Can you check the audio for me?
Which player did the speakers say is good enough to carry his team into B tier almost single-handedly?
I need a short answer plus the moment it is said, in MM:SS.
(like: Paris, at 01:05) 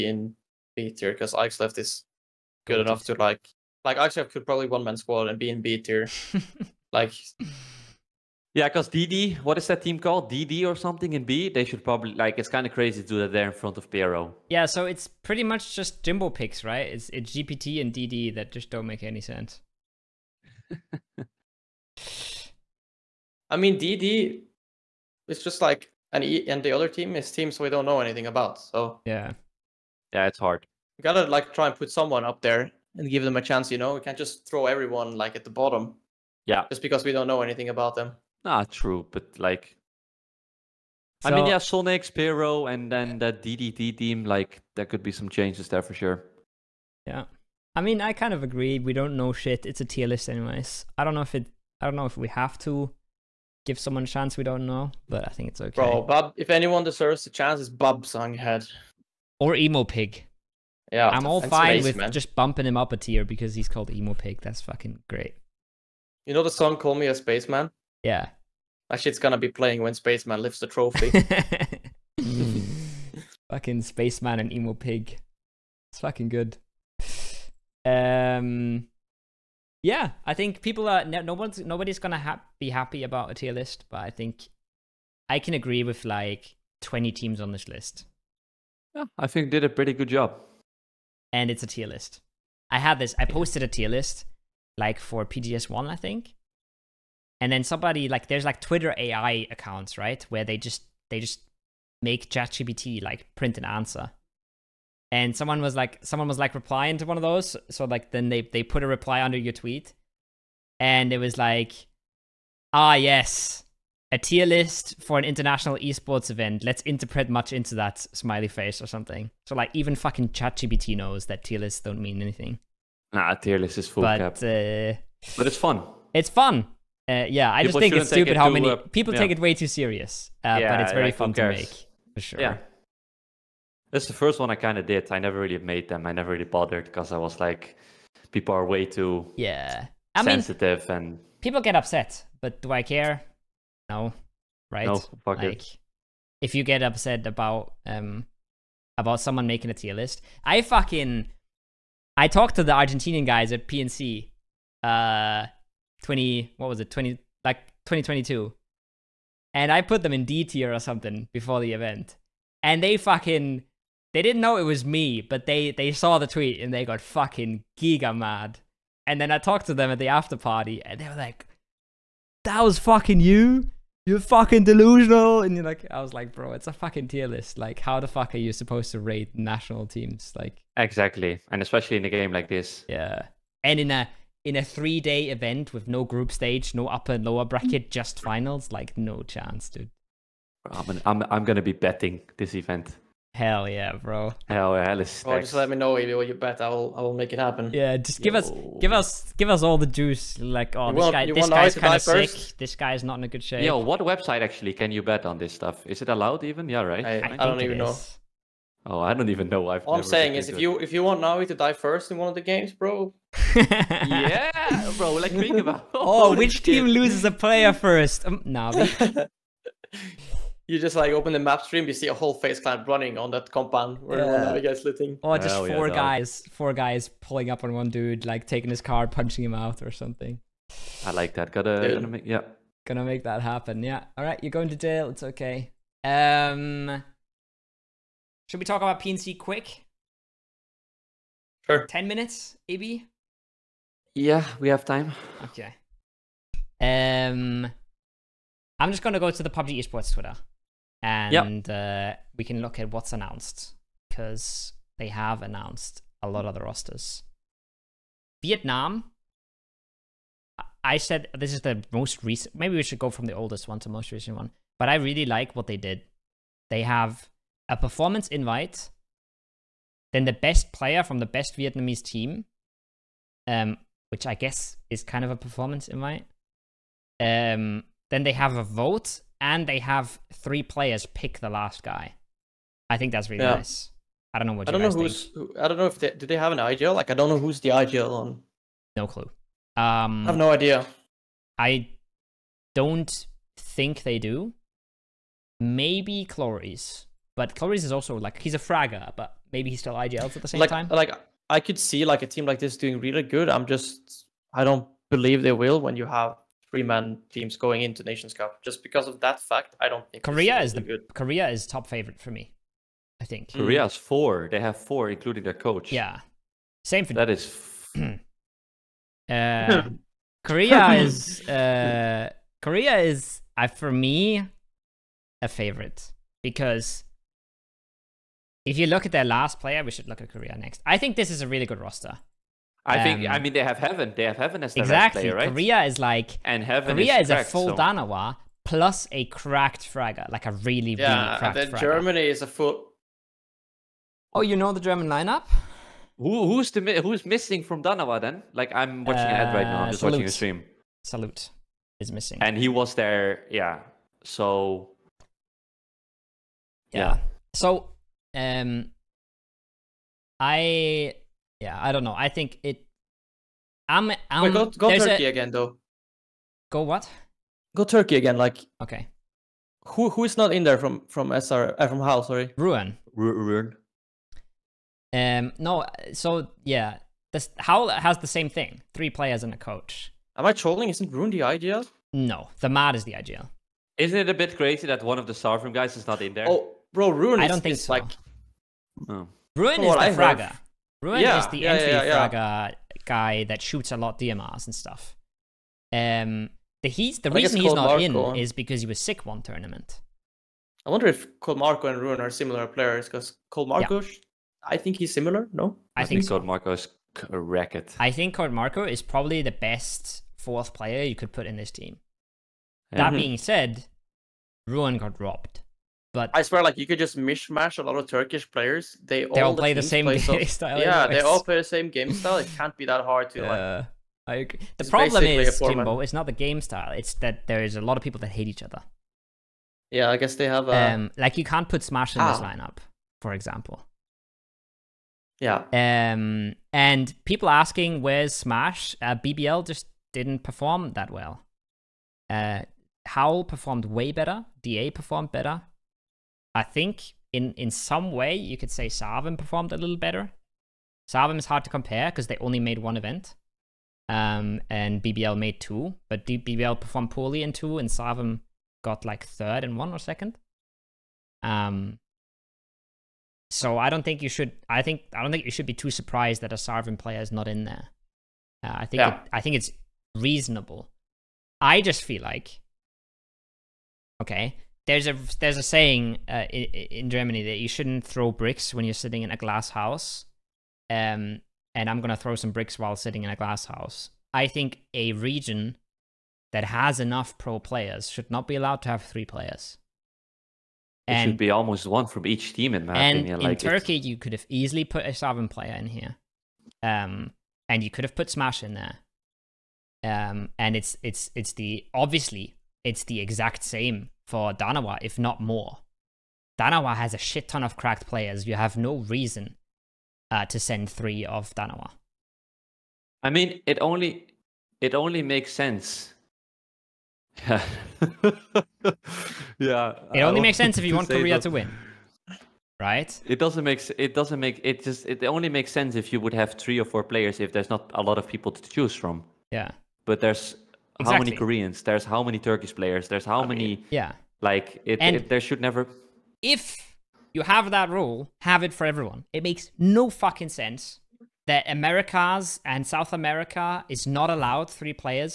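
Aixleft, at 00:01.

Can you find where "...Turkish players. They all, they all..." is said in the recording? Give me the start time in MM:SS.
06:58.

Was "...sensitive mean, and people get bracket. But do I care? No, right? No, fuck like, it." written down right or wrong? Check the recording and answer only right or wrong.
wrong.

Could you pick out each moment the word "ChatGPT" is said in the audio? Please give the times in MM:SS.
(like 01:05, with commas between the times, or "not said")
01:42, 02:00.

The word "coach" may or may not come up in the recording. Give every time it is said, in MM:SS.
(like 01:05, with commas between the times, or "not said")
05:15, 06:19.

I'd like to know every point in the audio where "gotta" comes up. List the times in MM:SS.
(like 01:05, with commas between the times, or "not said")
00:31, 03:51.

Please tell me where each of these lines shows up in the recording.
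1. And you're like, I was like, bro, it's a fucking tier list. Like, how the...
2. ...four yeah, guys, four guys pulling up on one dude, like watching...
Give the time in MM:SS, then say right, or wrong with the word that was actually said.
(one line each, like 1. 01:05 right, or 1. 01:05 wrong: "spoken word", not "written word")
1. 02:55 right
2. 03:45 wrong: "taking", not "watching".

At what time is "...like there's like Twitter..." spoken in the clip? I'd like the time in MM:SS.
01:38.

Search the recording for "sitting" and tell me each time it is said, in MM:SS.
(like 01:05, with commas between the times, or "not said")
07:58, 08:02.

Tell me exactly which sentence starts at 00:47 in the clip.
Yeah, I mean, I kind of agree.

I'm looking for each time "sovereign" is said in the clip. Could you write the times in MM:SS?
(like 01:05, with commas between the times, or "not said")
06:25, 08:15.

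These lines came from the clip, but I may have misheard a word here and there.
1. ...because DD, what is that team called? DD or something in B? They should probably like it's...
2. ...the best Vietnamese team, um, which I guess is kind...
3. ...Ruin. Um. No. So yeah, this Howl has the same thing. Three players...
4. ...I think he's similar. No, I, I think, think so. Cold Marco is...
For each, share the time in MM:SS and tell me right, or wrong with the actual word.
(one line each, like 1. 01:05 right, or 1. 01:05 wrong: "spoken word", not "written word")
1. 00:08 right
2. 04:31 right
3. 06:13 right
4. 06:44 right.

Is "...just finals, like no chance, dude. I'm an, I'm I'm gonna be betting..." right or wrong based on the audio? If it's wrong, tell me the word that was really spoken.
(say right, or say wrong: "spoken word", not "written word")
right.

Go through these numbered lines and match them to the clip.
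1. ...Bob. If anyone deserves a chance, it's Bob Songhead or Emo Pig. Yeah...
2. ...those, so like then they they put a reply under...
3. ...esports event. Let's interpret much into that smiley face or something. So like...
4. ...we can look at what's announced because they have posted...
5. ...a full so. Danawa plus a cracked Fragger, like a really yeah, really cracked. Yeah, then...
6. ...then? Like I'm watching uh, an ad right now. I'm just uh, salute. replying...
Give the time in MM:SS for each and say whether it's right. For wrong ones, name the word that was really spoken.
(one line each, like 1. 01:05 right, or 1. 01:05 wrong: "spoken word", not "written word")
1. 00:56 right
2. 01:47 right
3. 01:55 right
4. 04:12 wrong: "announced", not "posted"
5. 05:37 right
6. 05:48 wrong: "watching", not "replying".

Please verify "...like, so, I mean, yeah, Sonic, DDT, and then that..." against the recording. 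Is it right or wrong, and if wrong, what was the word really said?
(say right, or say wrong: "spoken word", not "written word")
wrong: "Spiro", not "DDT".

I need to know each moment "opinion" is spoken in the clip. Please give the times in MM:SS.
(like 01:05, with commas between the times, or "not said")
08:13.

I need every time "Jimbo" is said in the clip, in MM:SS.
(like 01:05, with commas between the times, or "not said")
00:16, 07:05.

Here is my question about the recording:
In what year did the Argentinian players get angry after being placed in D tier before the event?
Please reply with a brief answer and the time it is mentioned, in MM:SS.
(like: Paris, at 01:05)
2022, at 02:37.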